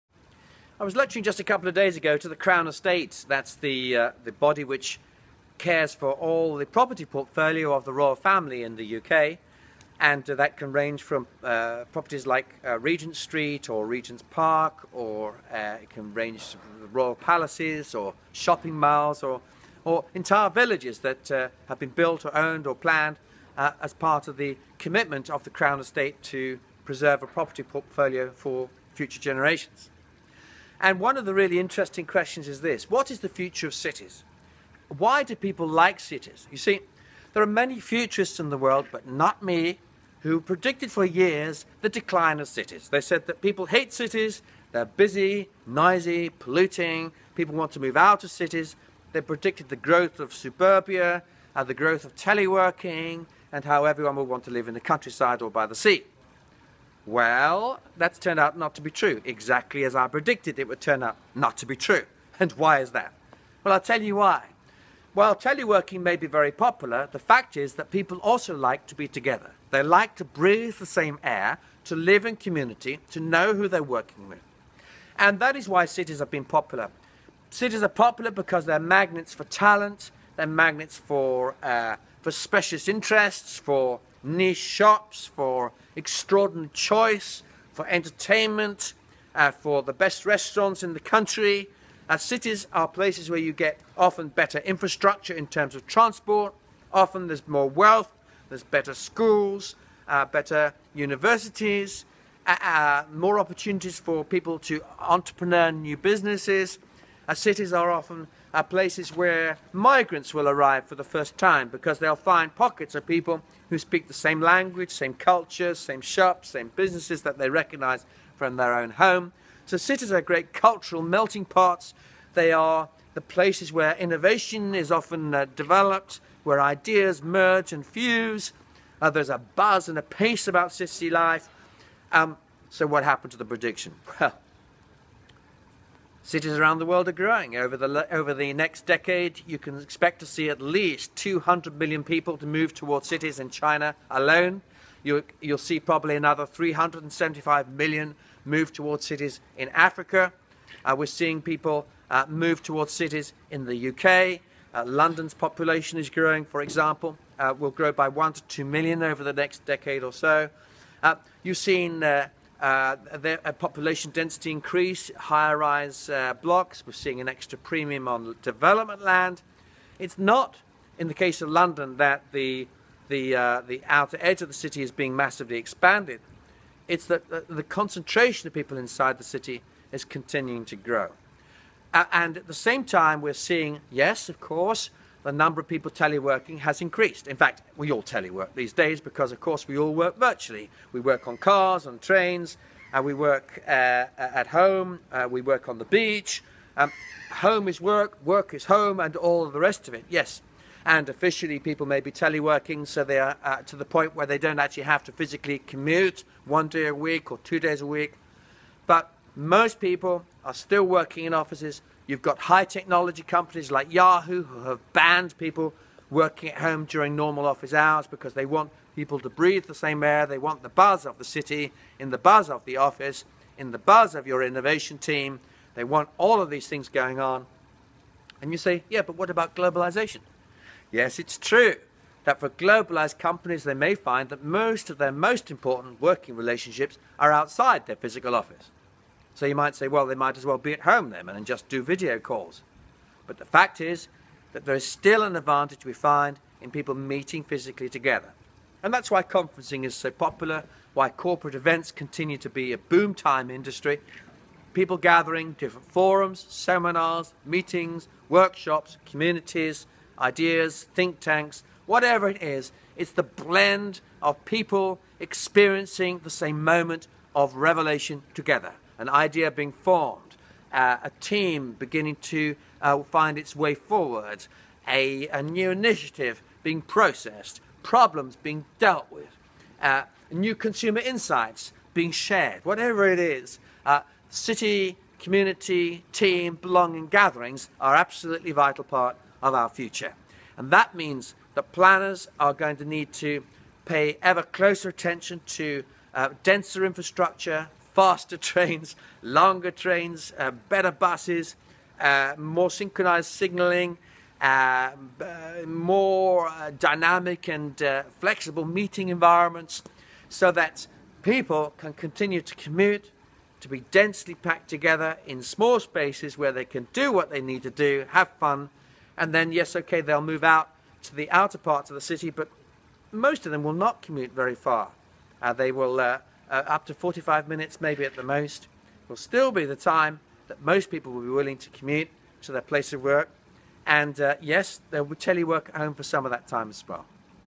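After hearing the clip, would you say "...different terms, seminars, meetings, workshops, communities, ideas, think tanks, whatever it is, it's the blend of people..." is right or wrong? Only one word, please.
wrong.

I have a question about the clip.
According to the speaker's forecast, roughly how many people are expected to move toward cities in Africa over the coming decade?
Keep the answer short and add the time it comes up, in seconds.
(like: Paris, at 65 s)
375 million, at 146 s.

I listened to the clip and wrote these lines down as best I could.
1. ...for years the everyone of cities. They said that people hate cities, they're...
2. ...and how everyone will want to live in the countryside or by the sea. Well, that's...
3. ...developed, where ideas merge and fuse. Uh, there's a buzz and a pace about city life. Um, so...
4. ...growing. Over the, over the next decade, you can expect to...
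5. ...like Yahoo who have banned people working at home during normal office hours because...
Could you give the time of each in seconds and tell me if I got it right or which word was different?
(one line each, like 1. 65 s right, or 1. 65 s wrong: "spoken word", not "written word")
1. 40 s wrong: "decline", not "everyone"
2. 53 s right
3. 125 s right
4. 137 s right
5. 213 s right.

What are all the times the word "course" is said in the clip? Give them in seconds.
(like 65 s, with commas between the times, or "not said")
184 s, 189 s.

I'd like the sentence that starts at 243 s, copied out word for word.
But the fact is that there is still an advantage we find in people meeting physically together.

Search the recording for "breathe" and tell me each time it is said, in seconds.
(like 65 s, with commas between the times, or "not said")
70 s, 219 s.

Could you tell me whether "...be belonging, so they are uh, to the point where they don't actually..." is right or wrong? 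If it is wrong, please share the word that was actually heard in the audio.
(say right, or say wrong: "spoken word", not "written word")
wrong: "teleworking", not "belonging".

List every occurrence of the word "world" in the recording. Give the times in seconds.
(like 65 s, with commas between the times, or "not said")
38 s, 136 s.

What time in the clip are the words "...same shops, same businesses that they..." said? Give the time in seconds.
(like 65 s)
115 s.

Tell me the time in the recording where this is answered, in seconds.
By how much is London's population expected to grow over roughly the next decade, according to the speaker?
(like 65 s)
158 s.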